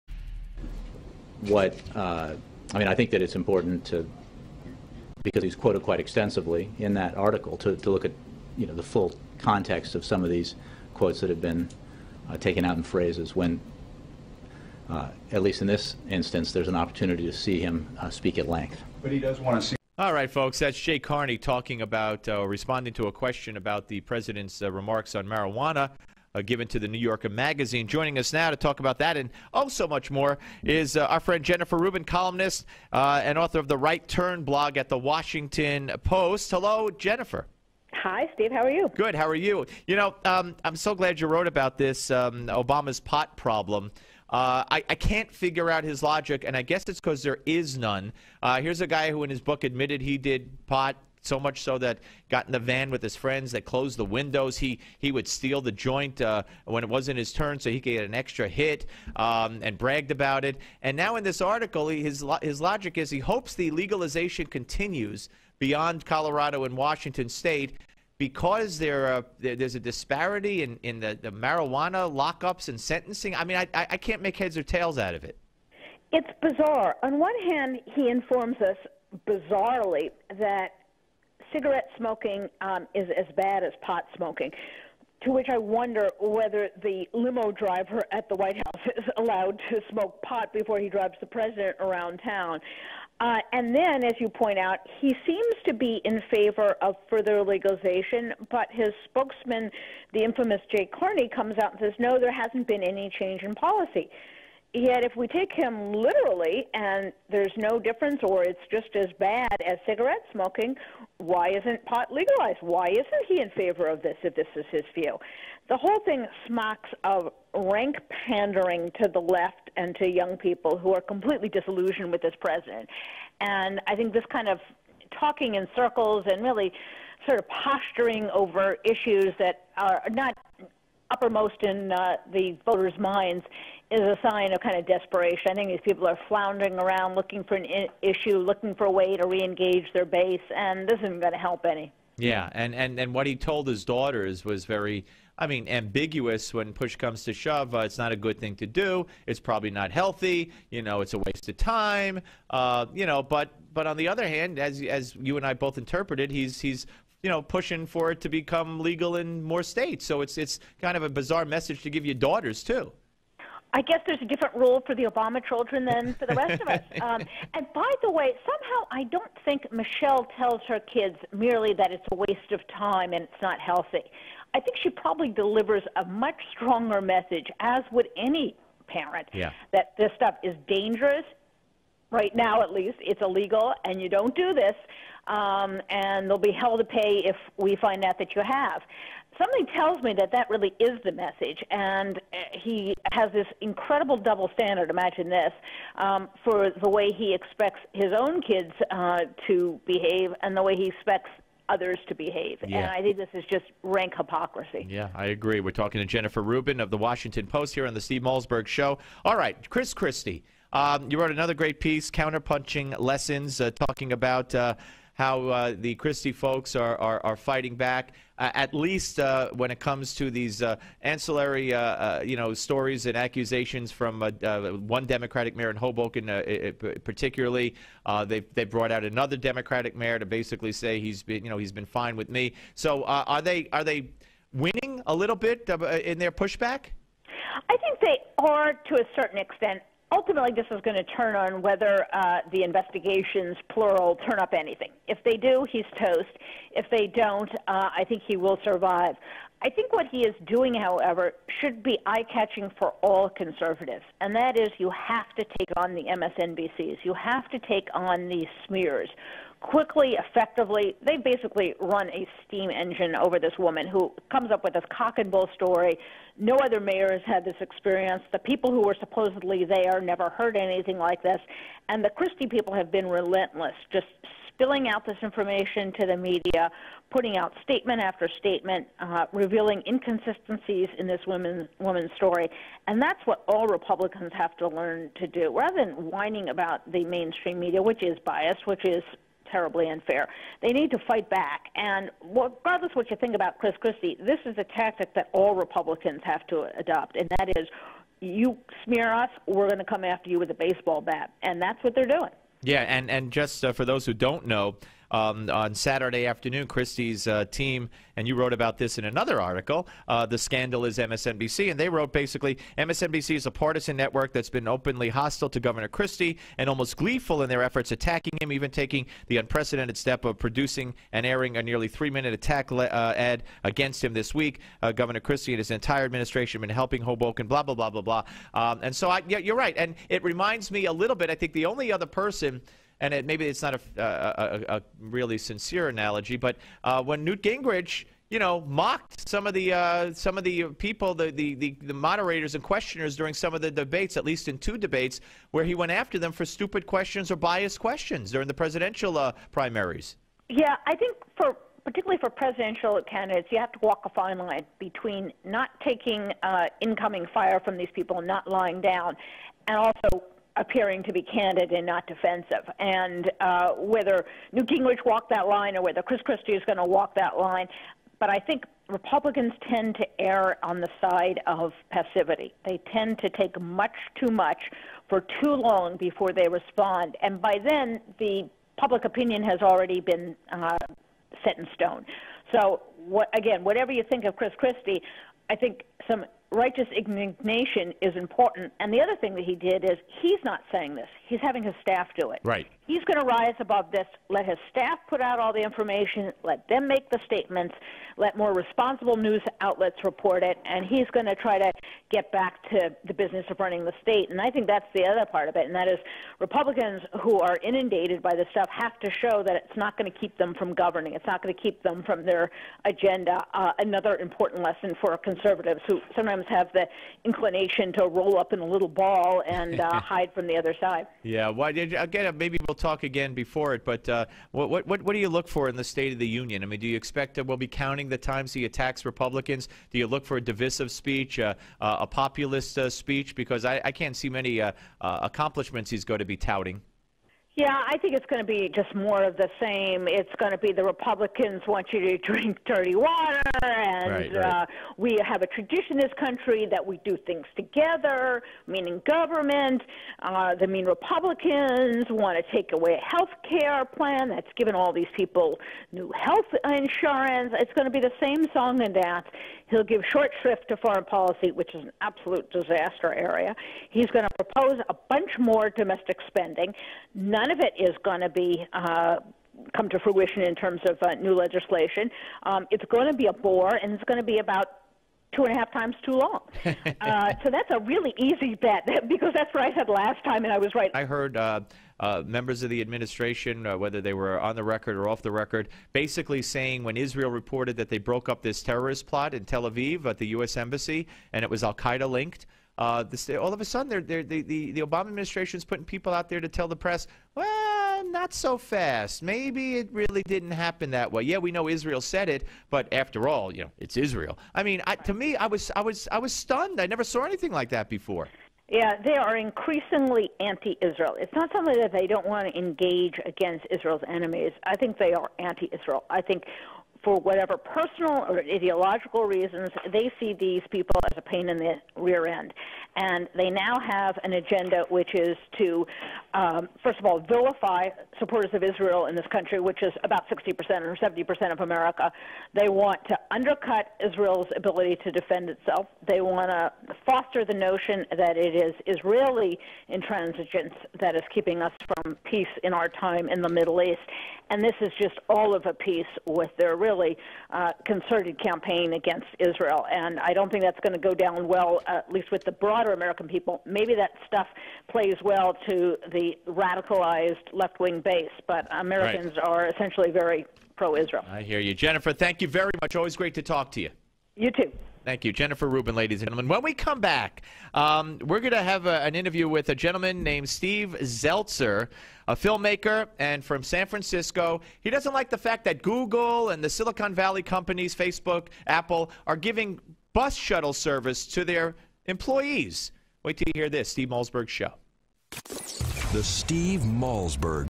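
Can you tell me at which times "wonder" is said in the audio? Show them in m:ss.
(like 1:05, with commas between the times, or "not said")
1:25.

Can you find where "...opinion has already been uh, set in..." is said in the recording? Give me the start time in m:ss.
6:19.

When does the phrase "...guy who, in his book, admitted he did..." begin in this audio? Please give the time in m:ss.
0:48.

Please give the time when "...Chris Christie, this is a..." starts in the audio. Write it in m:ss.
4:53.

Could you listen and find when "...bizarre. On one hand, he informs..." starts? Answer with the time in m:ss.
1:16.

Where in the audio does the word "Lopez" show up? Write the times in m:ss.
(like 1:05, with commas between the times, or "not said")
not said.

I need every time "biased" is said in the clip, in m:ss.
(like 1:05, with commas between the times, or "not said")
4:48, 5:47.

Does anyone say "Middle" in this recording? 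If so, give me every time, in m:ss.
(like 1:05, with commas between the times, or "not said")
9:03.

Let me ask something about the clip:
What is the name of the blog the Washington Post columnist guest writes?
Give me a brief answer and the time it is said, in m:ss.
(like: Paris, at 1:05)
Right Turn, at 0:33.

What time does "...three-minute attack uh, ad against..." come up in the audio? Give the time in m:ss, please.
5:21.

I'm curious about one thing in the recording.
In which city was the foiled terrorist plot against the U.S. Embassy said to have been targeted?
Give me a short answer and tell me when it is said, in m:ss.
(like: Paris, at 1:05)
Tel Aviv, at 8:09.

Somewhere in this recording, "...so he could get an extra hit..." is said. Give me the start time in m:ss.
0:57.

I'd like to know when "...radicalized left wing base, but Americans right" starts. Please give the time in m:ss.
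9:16.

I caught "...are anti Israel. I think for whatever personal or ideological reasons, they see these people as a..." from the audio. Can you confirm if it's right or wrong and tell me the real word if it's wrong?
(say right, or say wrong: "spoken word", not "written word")
right.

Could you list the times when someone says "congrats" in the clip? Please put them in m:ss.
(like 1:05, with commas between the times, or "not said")
not said.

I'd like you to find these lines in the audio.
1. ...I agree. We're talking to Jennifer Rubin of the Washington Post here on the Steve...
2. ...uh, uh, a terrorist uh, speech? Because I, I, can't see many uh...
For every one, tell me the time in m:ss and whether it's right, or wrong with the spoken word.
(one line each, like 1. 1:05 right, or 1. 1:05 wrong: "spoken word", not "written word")
1. 3:25 right
2. 7:11 wrong: "populist", not "terrorist".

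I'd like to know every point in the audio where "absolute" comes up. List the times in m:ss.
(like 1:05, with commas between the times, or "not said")
7:42.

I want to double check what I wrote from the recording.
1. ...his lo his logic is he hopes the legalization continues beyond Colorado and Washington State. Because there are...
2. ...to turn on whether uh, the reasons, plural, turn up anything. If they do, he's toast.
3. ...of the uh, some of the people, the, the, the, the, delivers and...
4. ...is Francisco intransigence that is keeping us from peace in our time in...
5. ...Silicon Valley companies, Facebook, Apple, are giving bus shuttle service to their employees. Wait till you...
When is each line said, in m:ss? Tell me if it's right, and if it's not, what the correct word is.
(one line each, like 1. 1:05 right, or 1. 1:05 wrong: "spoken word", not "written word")
1. 1:02 right
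2. 4:00 wrong: "investigations", not "reasons"
3. 5:39 wrong: "moderators", not "delivers"
4. 8:58 wrong: "Israeli", not "Francisco"
5. 9:36 right.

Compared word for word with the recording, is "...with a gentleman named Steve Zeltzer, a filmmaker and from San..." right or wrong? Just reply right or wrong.
right.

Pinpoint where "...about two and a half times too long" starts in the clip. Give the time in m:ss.
7:54.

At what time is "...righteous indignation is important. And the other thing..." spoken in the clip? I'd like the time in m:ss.
6:26.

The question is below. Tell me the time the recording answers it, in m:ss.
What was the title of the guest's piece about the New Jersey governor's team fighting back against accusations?
3:32.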